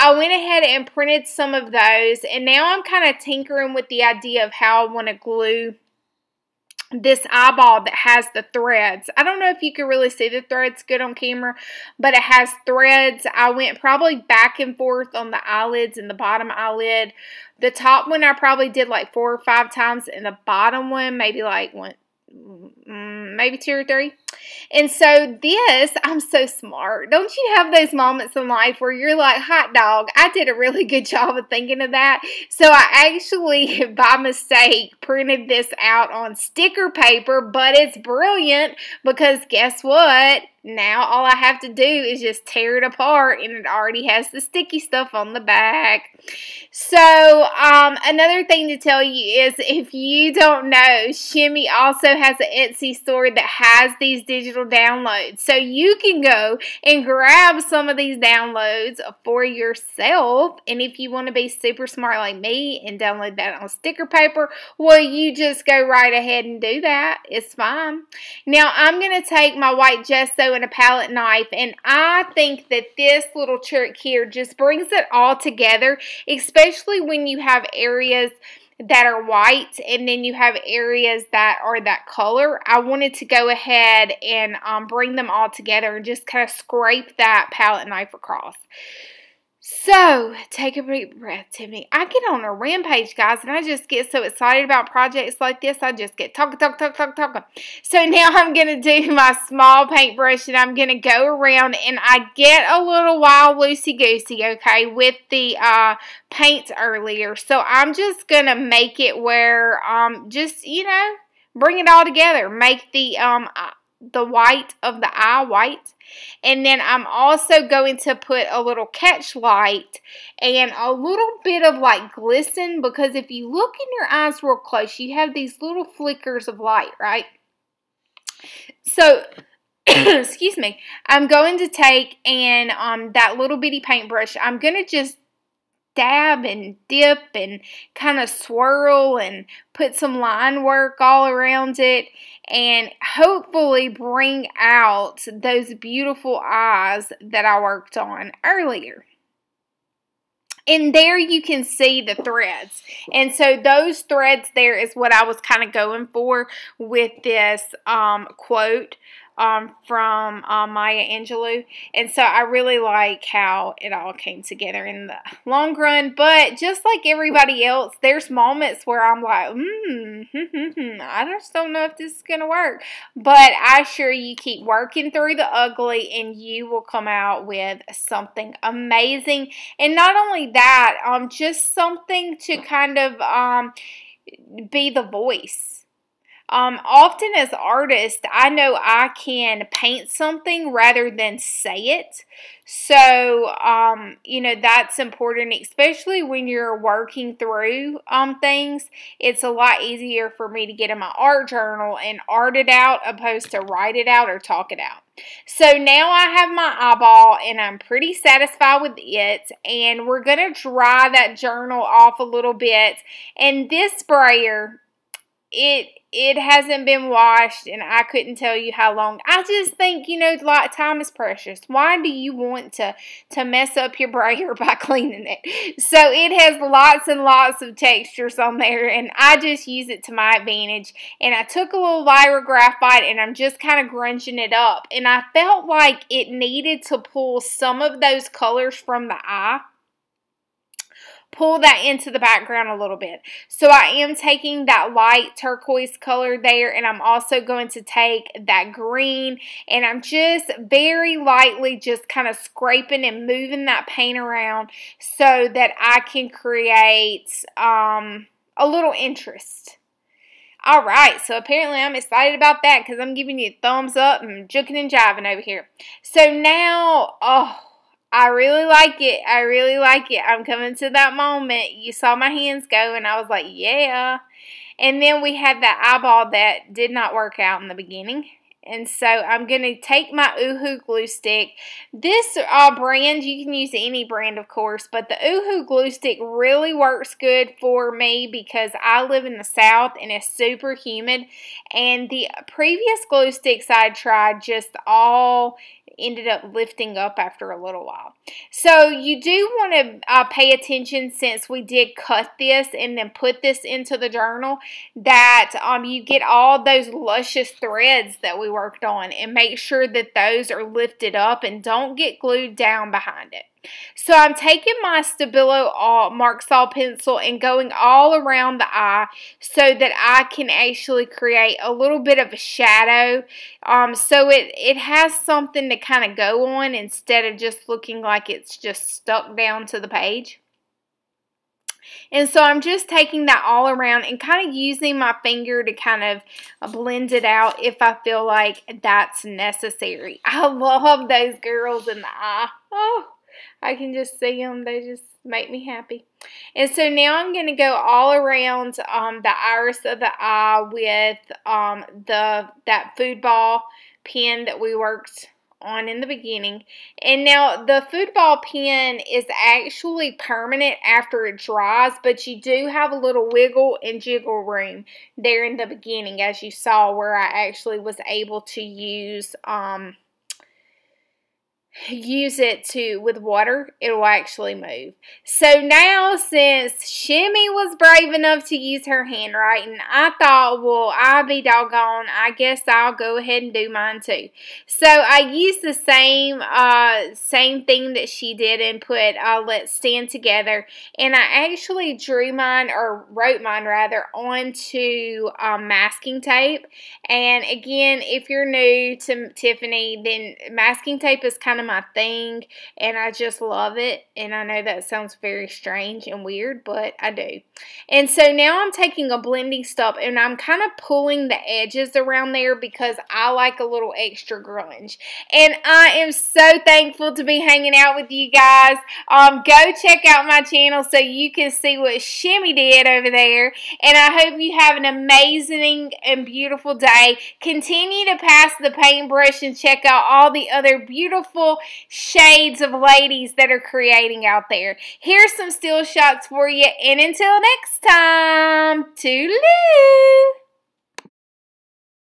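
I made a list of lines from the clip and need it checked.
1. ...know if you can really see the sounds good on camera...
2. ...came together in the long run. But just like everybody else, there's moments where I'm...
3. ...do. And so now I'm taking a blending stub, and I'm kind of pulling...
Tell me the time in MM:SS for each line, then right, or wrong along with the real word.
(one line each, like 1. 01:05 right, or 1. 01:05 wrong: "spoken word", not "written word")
1. 00:09 wrong: "threads", not "sounds"
2. 02:44 right
3. 06:47 right.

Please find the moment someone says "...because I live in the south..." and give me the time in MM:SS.
04:48.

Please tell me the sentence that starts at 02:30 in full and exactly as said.
And there you can see the threads.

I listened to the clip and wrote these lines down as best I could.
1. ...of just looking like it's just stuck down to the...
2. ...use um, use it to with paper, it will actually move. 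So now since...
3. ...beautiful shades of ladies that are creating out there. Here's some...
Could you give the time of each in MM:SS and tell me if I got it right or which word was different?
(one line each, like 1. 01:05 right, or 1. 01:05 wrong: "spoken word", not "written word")
1. 05:27 right
2. 06:08 wrong: "water", not "paper"
3. 07:10 right.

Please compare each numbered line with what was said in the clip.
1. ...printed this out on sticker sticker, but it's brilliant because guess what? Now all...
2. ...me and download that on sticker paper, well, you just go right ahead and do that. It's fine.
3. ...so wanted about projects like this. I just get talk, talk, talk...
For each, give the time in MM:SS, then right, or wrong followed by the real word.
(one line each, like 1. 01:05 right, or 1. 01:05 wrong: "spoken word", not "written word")
1. 00:34 wrong: "paper", not "sticker"
2. 01:02 right
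3. 01:34 wrong: "excited", not "wanted".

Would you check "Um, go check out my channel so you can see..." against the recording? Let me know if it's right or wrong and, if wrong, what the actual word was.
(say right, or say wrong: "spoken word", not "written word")
right.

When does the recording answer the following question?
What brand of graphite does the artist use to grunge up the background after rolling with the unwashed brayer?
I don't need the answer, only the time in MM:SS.
03:52.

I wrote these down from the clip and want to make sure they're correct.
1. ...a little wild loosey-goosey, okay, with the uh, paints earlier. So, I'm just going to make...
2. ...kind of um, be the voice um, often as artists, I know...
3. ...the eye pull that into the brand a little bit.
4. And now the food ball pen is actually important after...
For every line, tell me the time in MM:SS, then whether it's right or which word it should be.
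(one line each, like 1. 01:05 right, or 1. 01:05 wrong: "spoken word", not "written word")
1. 01:42 right
2. 03:02 right
3. 03:59 wrong: "background", not "brand"
4. 05:56 wrong: "permanent", not "important".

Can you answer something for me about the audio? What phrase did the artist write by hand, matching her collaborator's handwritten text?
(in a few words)
Let's stand together.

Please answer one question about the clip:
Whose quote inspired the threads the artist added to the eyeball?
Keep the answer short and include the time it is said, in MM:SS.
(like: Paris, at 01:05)
Maya Angelou, at 02:40.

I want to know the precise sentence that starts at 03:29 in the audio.
And we're going to dry that journal off a little bit.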